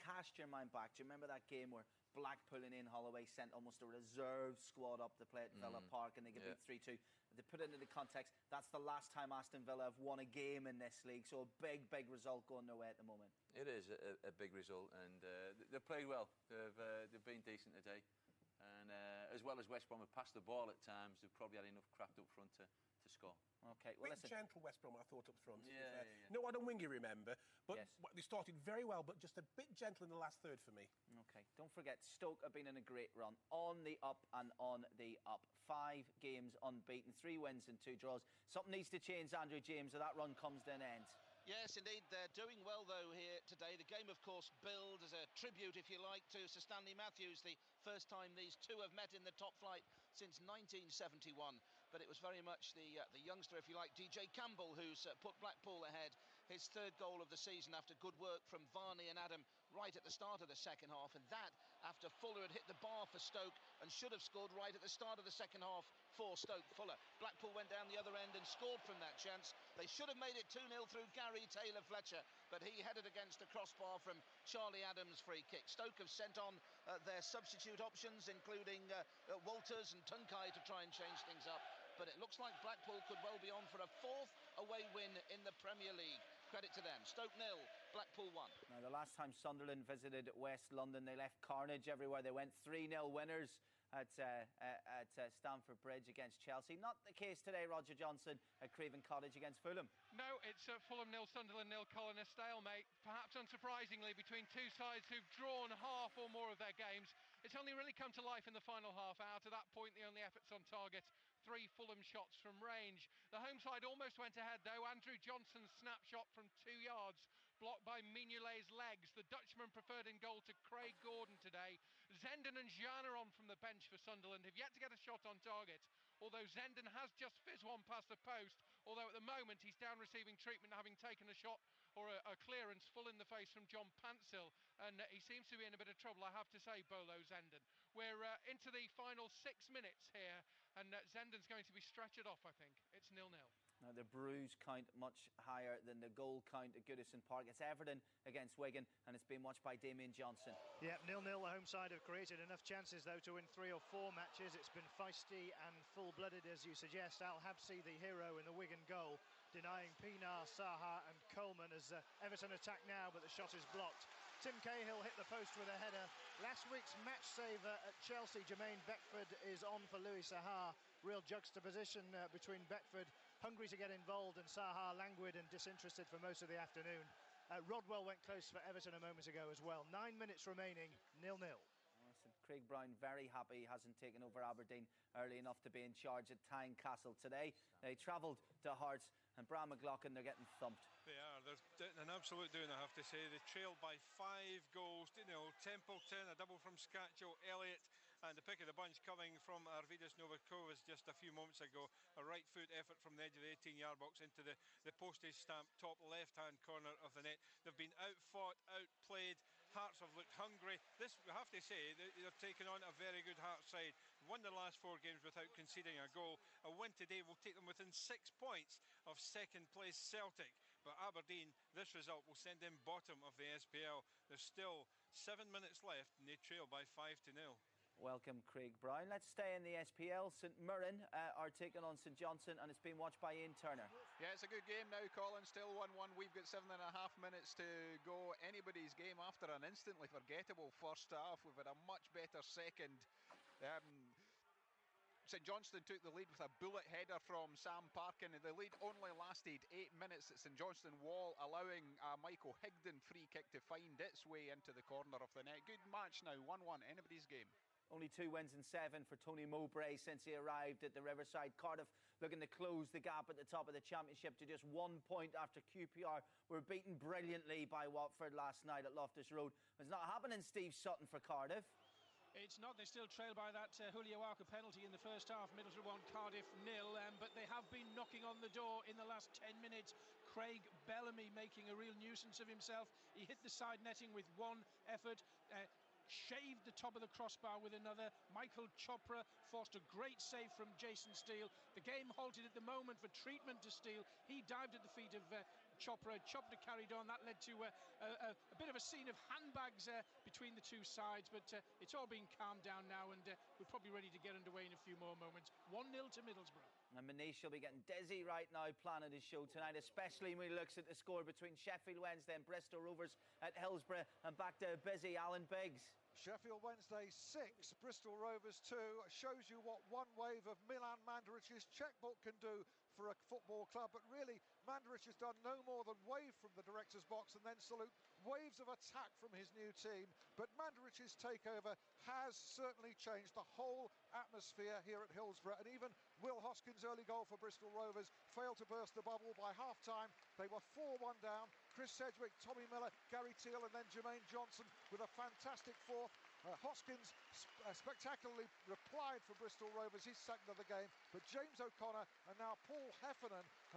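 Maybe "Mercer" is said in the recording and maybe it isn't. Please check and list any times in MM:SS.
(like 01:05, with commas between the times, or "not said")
not said.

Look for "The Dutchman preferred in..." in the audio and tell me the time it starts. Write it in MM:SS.
01:59.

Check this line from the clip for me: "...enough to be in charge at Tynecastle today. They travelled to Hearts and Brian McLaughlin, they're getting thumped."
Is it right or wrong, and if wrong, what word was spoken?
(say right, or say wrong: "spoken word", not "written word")
right.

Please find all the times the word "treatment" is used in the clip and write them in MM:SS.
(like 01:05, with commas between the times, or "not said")
02:10, 04:53.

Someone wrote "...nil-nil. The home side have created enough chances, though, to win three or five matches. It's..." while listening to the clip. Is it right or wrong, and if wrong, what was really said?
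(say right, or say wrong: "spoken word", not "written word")
wrong: "four", not "five".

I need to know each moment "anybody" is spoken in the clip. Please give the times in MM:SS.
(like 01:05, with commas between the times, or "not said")
03:58, 04:16.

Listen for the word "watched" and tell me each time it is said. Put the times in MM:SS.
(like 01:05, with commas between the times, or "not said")
02:29, 03:52.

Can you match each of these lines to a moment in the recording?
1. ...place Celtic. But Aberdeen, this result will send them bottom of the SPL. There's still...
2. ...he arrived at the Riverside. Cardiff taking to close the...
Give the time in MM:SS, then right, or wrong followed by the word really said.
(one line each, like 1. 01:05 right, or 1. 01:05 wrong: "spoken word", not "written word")
1. 03:39 right
2. 04:20 wrong: "looking", not "taking".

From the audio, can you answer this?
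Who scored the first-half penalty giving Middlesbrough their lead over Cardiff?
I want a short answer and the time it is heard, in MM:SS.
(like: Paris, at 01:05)
Julio Arca, at 04:33.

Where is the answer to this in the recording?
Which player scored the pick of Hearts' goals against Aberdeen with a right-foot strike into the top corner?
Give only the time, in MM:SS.
03:19.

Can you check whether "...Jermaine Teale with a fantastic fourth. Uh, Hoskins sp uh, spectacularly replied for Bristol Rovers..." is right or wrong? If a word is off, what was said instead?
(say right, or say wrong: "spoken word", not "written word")
wrong: "Johnson", not "Teale".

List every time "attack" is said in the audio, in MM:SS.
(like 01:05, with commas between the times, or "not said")
02:42, 05:28.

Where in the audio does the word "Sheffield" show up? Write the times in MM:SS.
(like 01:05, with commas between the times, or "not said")
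05:11, 05:16.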